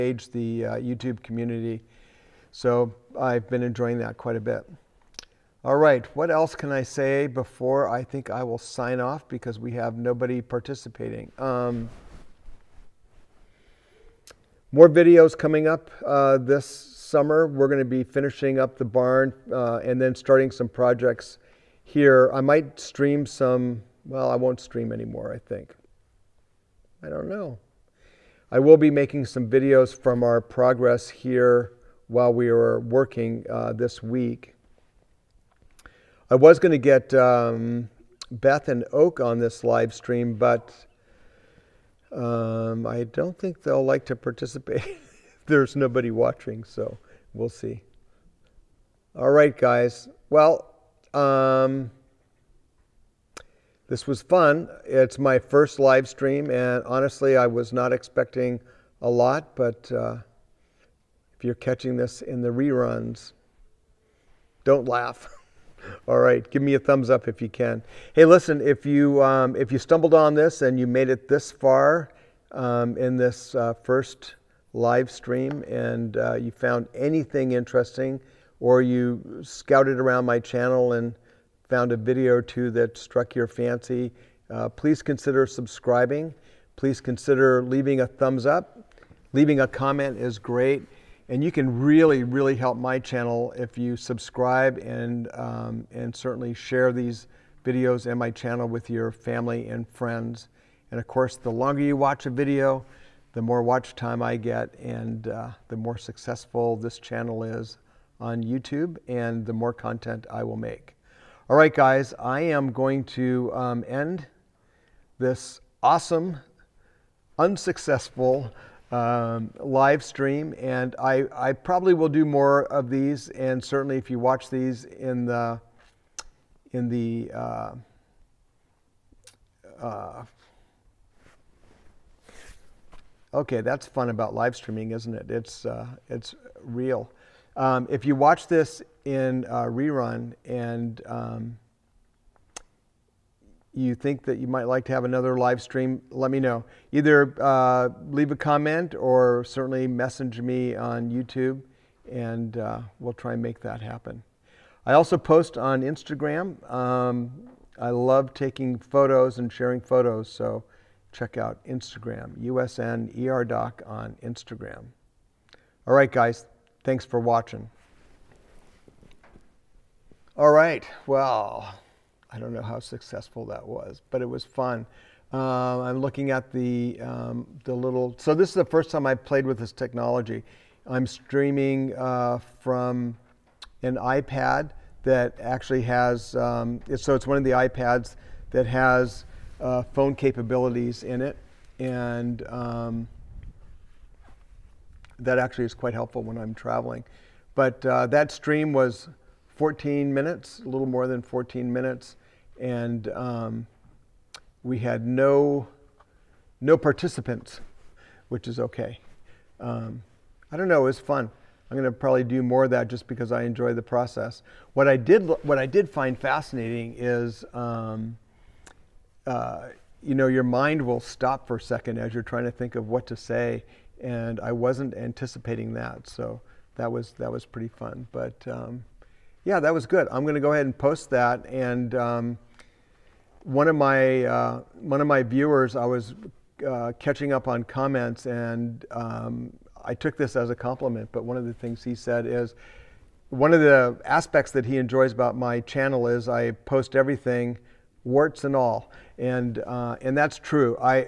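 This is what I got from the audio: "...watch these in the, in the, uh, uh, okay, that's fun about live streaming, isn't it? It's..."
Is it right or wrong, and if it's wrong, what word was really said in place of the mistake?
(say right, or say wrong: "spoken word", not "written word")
right.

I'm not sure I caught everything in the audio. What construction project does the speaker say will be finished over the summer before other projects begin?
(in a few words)
the barn.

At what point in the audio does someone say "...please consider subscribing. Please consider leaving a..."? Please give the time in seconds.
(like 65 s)
84 s.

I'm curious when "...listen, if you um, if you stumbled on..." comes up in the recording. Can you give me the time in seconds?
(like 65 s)
68 s.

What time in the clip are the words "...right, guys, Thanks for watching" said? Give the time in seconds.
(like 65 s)
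165 s.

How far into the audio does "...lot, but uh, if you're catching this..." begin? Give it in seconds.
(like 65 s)
59 s.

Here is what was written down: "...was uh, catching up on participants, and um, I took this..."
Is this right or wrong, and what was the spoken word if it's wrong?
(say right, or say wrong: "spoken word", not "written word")
wrong: "comments", not "participants".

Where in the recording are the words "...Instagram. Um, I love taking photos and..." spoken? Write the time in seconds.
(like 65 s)
155 s.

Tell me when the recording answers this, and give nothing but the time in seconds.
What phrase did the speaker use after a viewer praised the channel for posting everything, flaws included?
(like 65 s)
248 s.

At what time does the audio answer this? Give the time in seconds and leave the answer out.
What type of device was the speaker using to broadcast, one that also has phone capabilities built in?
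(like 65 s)
183 s.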